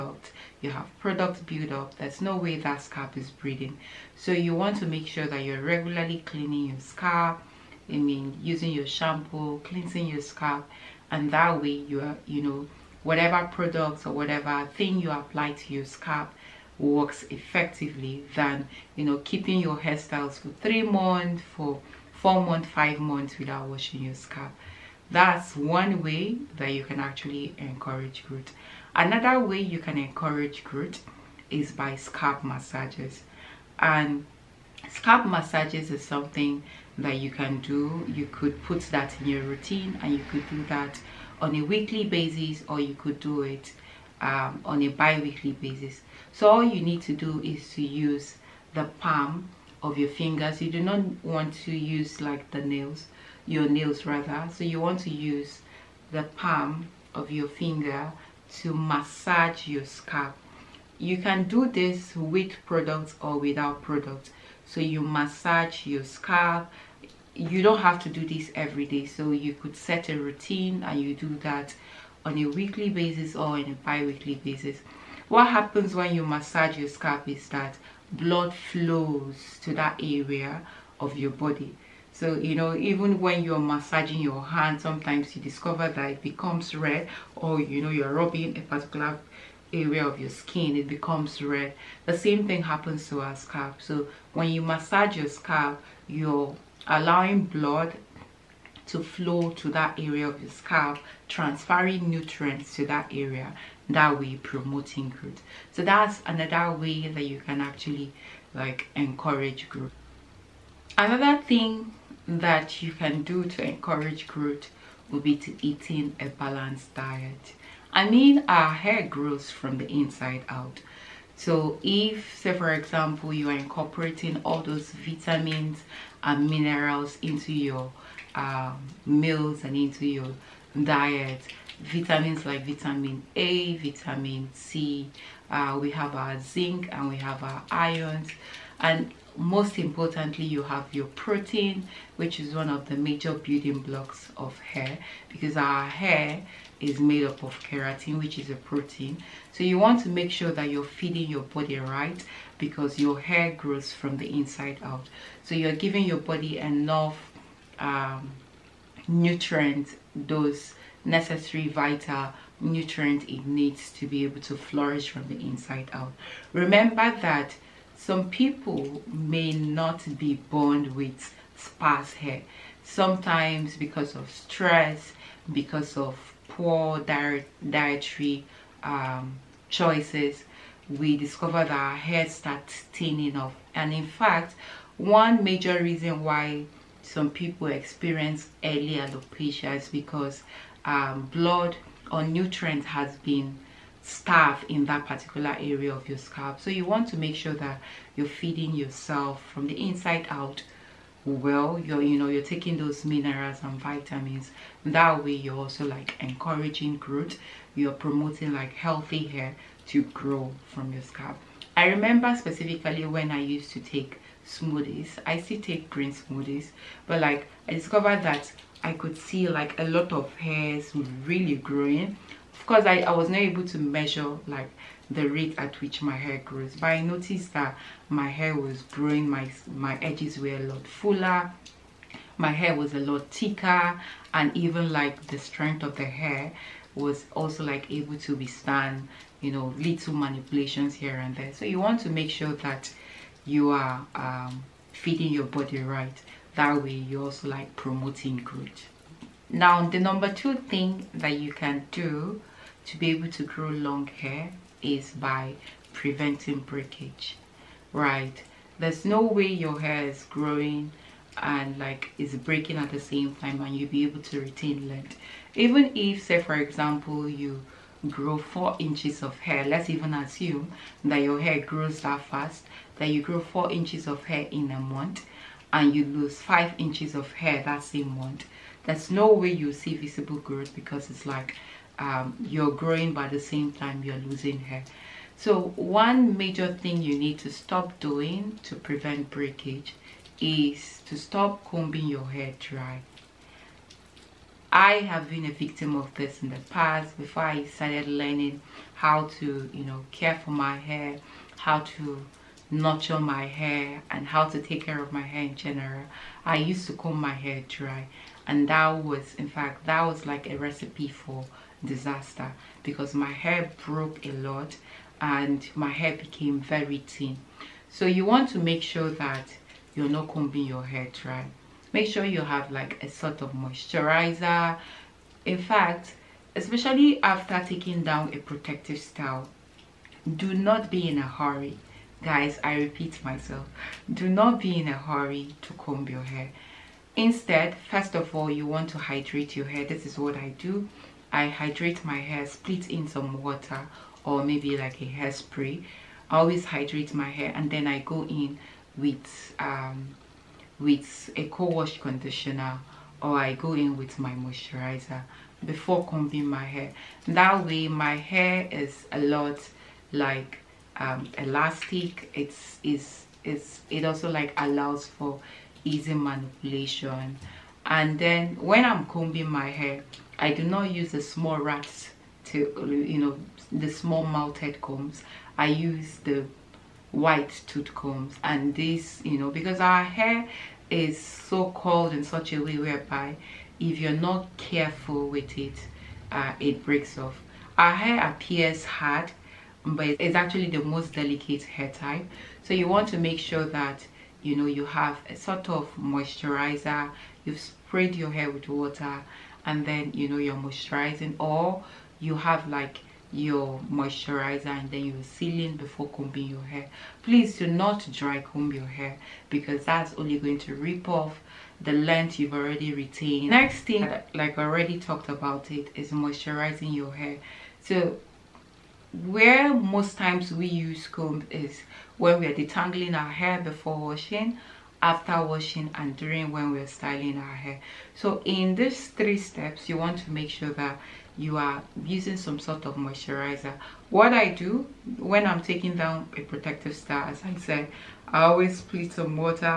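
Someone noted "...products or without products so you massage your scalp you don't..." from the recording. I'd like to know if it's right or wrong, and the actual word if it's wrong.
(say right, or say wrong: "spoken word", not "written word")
right.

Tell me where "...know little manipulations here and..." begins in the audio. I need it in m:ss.
3:59.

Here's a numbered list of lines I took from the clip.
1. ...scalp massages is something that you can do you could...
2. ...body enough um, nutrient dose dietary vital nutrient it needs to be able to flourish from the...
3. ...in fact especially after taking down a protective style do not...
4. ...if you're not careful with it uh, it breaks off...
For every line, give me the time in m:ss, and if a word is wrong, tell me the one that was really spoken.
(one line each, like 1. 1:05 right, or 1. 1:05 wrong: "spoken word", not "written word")
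1. 0:34 right
2. 2:36 wrong: "necessary", not "dietary"
3. 5:25 right
4. 6:23 right.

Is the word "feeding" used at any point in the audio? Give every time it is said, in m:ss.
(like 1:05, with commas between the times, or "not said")
2:30, 3:18, 4:04.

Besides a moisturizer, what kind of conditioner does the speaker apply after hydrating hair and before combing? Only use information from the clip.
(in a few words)
Co-wash conditioner.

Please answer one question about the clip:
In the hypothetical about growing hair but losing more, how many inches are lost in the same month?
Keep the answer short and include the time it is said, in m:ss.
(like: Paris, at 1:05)
5 inches, at 4:36.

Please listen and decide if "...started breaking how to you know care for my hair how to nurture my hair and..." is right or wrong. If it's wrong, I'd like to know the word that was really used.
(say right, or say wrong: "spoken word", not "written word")
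wrong: "learning", not "breaking".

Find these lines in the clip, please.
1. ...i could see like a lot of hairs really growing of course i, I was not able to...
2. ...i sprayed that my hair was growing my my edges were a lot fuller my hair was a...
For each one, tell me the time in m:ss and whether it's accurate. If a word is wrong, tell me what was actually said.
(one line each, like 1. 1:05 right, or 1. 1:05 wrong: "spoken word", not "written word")
1. 3:38 right
2. 3:46 wrong: "noticed", not "sprayed".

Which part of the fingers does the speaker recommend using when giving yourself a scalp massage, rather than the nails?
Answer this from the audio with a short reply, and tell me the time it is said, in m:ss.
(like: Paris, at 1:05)
Palm of your fingers, at 0:48.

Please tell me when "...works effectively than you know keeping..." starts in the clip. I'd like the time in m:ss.
0:16.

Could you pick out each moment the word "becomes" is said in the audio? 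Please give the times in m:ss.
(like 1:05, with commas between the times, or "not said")
1:26, 1:30.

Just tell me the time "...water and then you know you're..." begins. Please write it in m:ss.
6:38.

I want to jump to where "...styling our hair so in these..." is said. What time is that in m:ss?
7:06.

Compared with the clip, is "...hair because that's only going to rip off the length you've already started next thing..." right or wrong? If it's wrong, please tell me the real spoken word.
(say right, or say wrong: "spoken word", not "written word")
wrong: "retained", not "started".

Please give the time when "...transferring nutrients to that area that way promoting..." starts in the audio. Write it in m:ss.
1:41.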